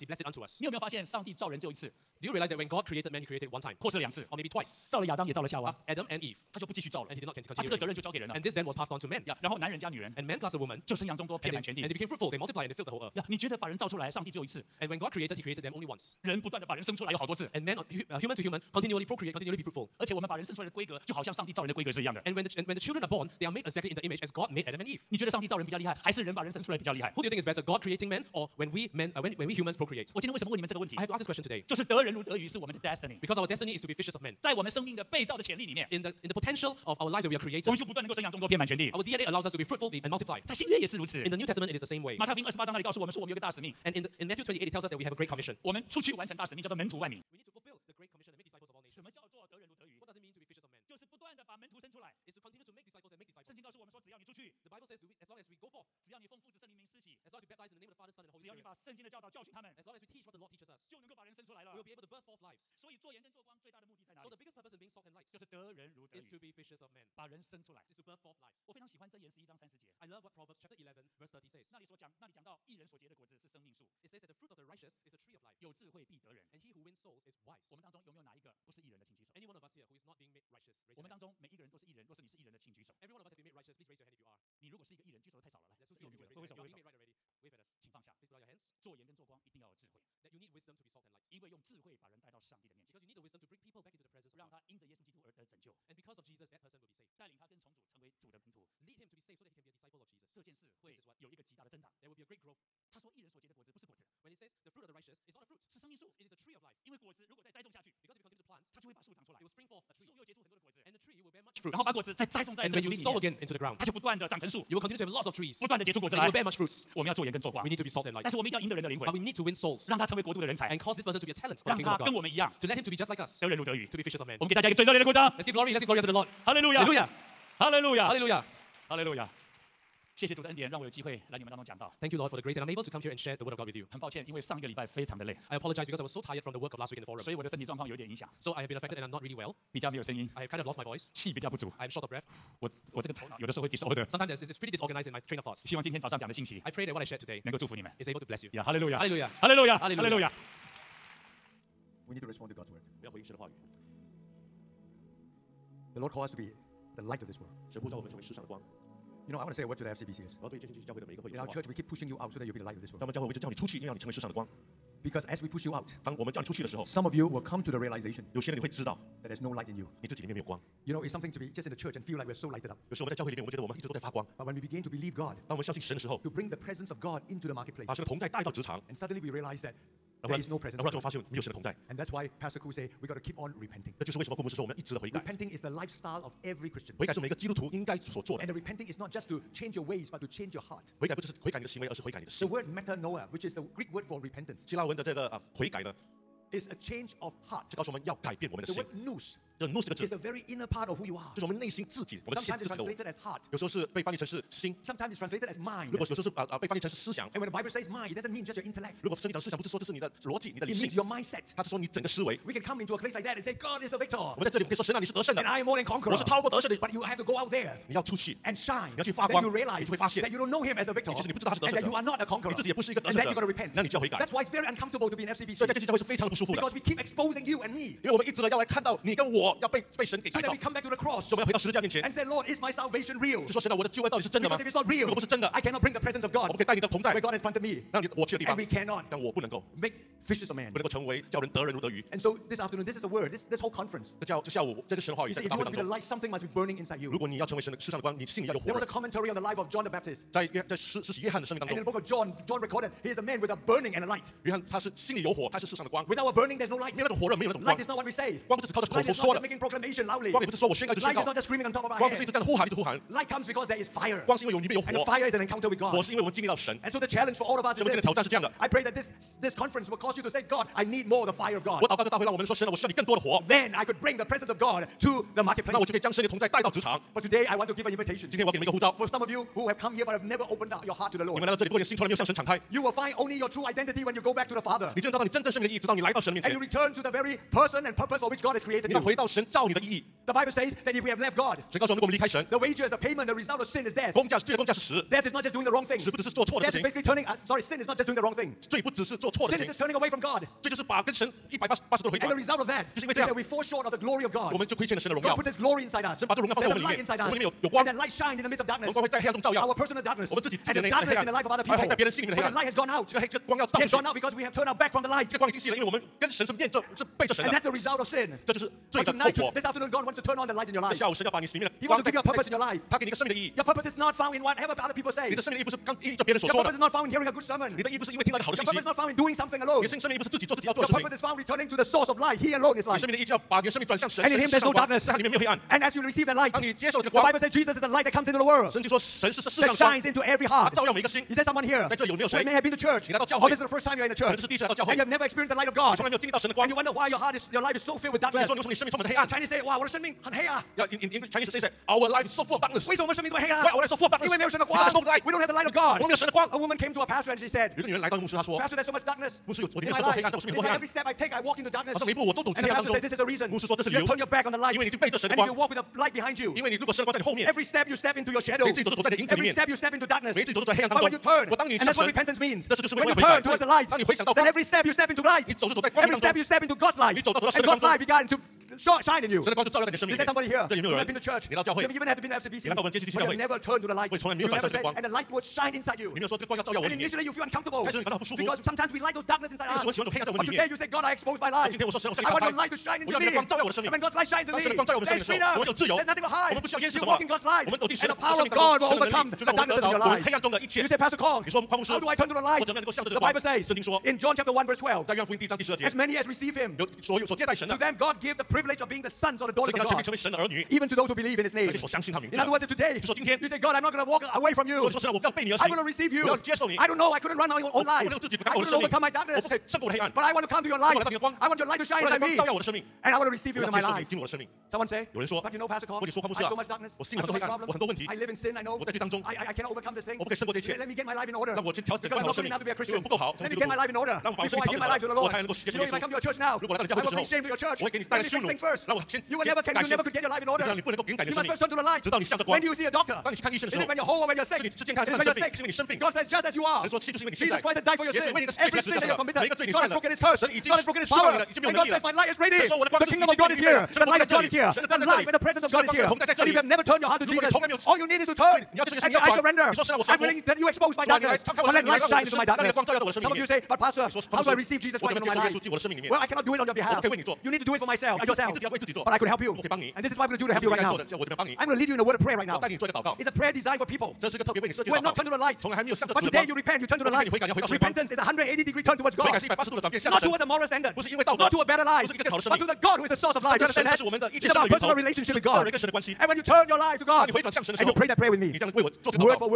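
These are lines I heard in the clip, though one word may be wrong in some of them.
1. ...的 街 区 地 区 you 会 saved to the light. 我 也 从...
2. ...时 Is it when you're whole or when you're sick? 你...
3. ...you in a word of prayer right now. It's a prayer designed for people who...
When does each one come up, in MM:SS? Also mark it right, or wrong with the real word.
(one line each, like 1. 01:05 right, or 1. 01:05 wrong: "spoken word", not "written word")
1. 06:22 wrong: "turned", not "saved"
2. 07:23 right
3. 07:51 right.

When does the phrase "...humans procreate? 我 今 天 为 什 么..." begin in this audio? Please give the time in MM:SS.
00:29.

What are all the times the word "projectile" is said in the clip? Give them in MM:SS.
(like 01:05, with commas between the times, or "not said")
not said.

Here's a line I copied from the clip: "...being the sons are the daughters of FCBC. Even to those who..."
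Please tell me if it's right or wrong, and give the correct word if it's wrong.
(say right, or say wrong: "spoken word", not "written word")
wrong: "God", not "FCBC".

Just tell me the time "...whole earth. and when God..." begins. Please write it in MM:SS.
00:12.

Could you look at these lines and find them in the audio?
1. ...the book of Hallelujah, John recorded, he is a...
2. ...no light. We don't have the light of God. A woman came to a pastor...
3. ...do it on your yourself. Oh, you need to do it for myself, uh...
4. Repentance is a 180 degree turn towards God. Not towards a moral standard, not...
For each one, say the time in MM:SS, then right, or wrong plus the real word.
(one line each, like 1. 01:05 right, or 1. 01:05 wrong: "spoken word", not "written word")
1. 04:11 wrong: "John", not "Hallelujah"
2. 05:54 right
3. 07:46 wrong: "behalf", not "yourself"
4. 07:57 right.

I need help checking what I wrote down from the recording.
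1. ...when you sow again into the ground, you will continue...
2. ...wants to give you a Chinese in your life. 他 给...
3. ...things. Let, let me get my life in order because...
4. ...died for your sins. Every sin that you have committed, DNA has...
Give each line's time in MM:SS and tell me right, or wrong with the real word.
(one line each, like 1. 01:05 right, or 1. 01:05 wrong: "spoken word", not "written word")
1. 01:52 right
2. 05:21 wrong: "purpose", not "Chinese"
3. 07:10 right
4. 07:27 wrong: "God", not "DNA".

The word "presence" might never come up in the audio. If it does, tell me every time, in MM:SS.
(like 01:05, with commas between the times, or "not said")
01:34, 02:56, 03:00, 03:55, 04:34, 07:35.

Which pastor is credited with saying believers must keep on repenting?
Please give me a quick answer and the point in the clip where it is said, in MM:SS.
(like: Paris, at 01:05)
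Pastor Ku, at 03:02.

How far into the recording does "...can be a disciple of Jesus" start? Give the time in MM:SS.
01:39.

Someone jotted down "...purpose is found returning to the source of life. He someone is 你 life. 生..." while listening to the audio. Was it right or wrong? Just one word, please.
wrong.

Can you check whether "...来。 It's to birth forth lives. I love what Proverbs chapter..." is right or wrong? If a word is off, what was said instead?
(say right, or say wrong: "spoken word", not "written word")
right.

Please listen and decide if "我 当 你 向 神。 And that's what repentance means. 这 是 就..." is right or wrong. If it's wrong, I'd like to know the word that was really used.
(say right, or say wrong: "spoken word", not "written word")
right.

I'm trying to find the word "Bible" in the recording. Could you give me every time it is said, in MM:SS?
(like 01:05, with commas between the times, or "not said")
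00:54, 03:27, 04:50, 05:37, 06:43.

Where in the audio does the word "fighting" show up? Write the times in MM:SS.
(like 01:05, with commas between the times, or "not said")
not said.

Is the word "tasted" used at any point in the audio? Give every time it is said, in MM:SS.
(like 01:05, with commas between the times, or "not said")
not said.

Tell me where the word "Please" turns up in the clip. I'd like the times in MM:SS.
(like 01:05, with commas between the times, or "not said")
01:23, 01:28.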